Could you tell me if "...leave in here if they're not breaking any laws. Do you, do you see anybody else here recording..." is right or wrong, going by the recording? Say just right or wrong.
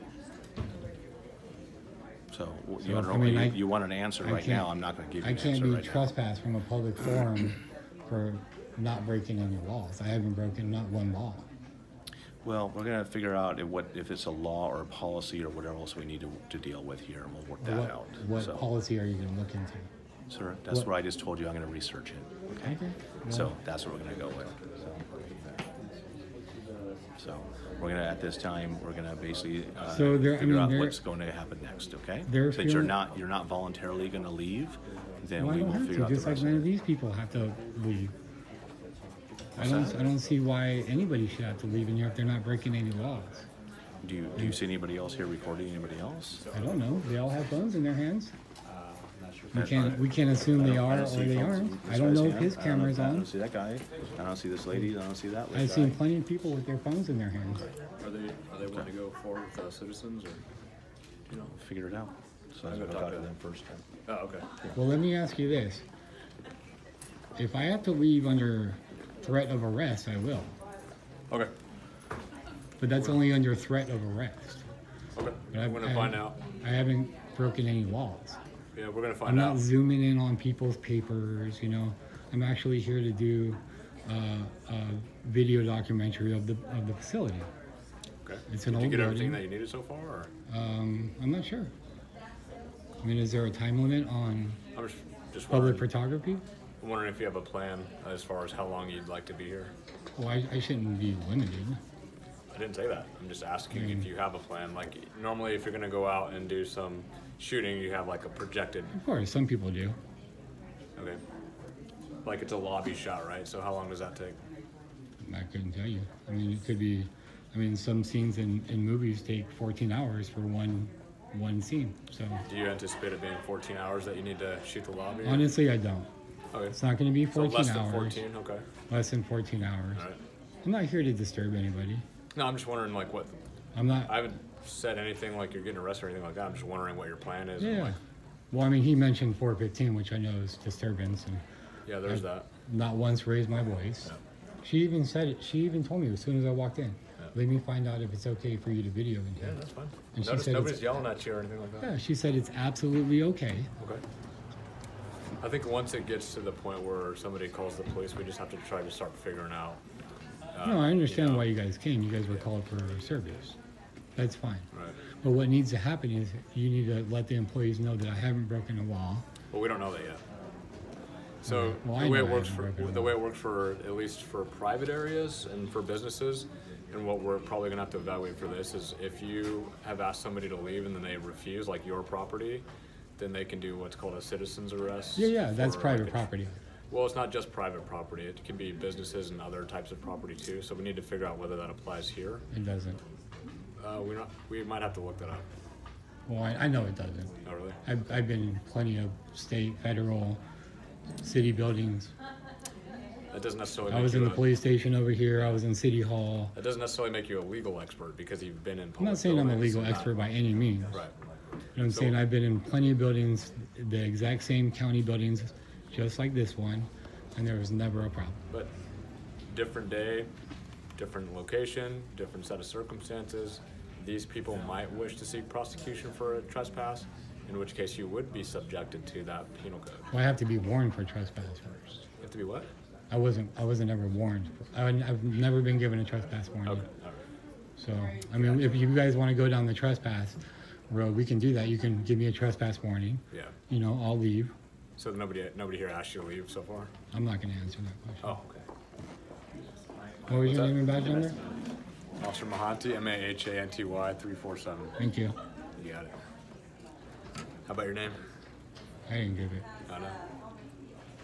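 right.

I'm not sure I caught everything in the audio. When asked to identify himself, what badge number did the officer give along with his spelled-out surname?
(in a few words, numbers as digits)
347.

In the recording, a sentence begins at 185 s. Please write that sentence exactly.
Yeah, yeah, that's private like, property.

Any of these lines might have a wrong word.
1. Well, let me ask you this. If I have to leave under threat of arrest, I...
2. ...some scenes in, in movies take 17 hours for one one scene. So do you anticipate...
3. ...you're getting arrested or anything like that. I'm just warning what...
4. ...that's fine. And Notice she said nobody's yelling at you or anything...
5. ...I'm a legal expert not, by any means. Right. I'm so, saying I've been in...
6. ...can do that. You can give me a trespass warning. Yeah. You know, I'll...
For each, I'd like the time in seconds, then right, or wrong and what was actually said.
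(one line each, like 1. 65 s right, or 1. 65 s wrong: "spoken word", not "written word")
1. 64 s right
2. 117 s wrong: "14", not "17"
3. 135 s wrong: "wondering", not "warning"
4. 149 s right
5. 209 s right
6. 241 s right.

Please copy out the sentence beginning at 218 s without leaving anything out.
But different day, different location, different set of circumstances.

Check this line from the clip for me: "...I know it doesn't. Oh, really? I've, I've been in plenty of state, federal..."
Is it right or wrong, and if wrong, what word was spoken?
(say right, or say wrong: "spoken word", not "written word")
right.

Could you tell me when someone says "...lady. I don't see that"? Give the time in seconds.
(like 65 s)
54 s.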